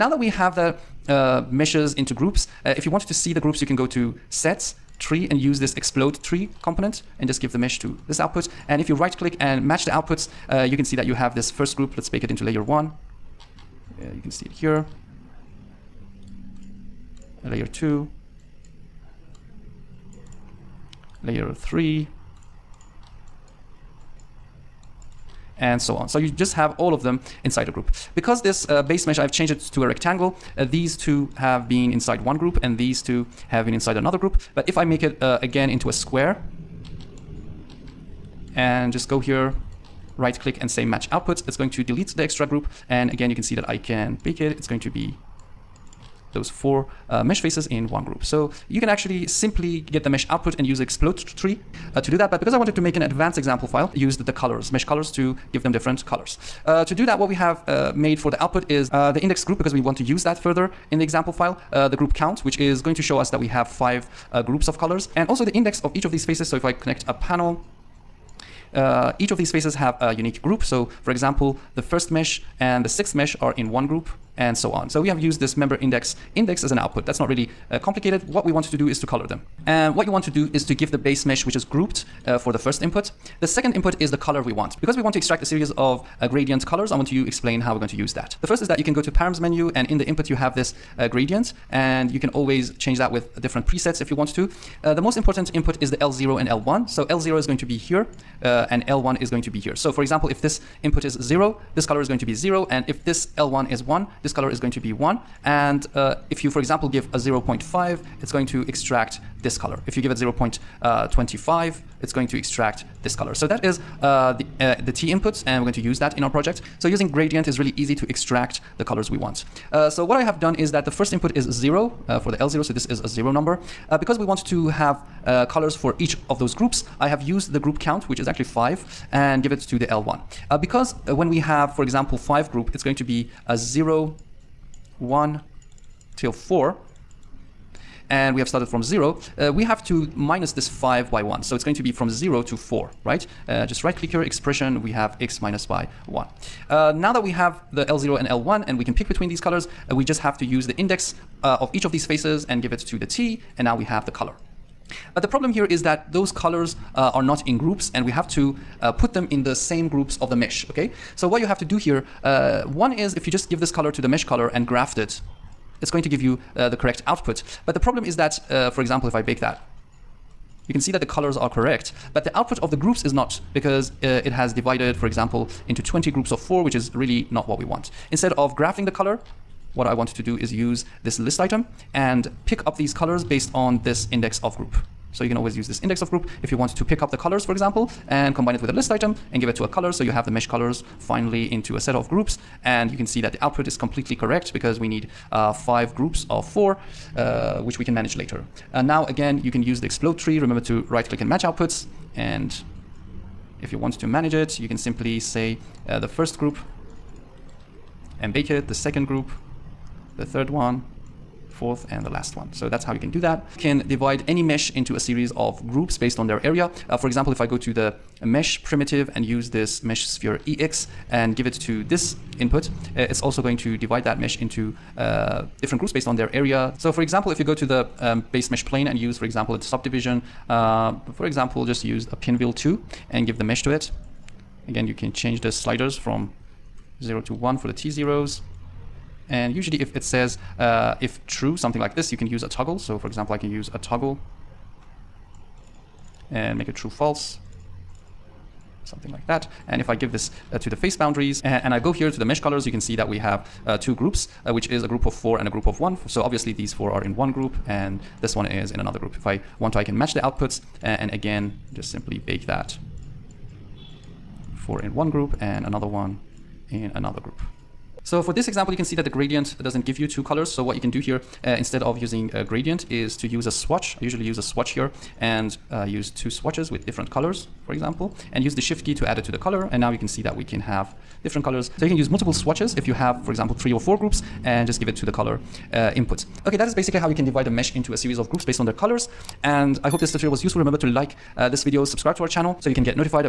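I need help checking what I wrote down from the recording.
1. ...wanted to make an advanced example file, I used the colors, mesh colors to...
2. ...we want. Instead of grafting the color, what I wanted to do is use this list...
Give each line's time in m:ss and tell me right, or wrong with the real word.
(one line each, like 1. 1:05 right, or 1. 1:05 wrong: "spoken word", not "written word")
1. 0:52 right
2. 2:57 right.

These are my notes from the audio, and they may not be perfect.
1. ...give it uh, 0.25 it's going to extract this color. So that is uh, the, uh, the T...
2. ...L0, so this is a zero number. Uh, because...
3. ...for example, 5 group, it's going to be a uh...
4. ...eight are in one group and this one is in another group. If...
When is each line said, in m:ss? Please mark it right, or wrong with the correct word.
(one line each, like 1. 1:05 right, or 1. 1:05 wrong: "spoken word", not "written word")
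1. 1:50 right
2. 2:02 right
3. 2:11 right
4. 4:16 wrong: "four", not "eight".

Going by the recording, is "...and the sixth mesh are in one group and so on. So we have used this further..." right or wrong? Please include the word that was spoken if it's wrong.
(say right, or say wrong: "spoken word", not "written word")
wrong: "member", not "further".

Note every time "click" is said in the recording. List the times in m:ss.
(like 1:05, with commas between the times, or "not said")
0:09, 0:40, 2:23, 3:21.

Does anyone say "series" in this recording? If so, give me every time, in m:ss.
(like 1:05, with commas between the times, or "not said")
1:25, 3:35, 4:47.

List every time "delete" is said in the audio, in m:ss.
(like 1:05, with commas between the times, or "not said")
0:41.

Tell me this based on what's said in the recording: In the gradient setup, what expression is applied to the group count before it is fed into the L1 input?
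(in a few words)
x minus 1.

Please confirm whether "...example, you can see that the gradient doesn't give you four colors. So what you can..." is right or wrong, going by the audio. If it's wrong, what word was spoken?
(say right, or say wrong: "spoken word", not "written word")
wrong: "two", not "four".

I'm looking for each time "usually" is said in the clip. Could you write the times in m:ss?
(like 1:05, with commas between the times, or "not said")
3:59, 4:34.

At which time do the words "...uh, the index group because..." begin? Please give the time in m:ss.
0:58.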